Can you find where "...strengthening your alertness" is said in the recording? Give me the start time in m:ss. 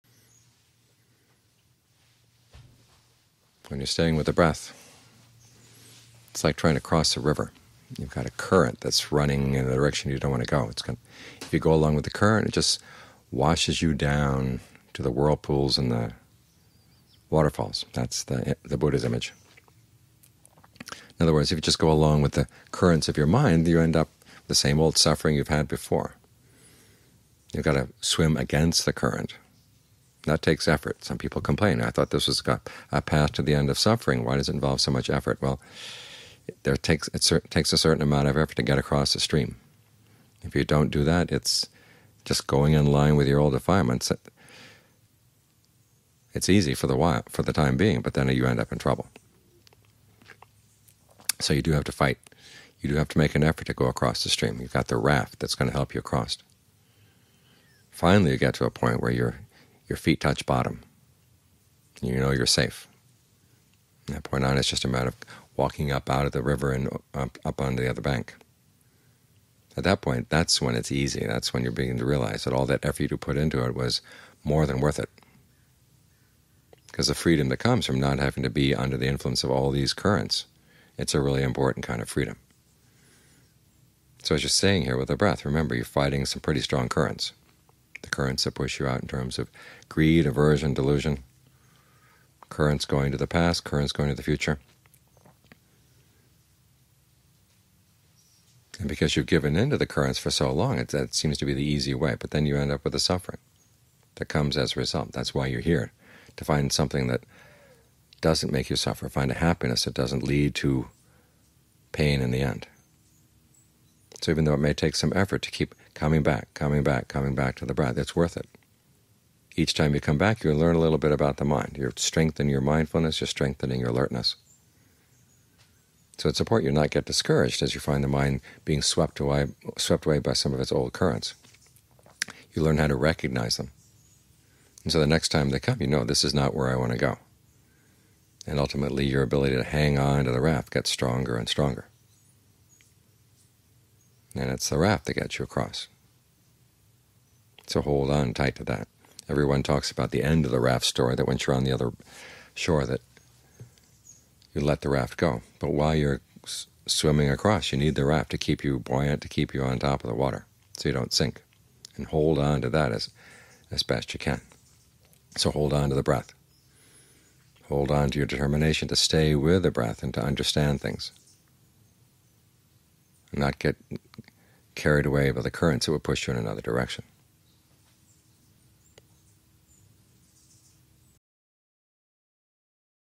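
2:03.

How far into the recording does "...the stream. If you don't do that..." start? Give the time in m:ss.
0:39.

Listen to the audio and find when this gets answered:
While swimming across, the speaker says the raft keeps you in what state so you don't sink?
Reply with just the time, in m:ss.
2:38.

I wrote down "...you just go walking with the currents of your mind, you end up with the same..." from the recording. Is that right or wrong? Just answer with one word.
wrong.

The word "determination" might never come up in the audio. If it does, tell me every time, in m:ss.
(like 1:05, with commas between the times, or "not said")
2:48.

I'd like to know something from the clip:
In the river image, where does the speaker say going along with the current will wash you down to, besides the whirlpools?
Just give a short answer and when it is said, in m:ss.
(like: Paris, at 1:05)
the waterfalls, at 0:15.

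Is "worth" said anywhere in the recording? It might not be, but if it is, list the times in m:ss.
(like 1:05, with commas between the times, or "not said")
1:14, 1:58.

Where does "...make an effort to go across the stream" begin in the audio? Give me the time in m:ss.
0:53.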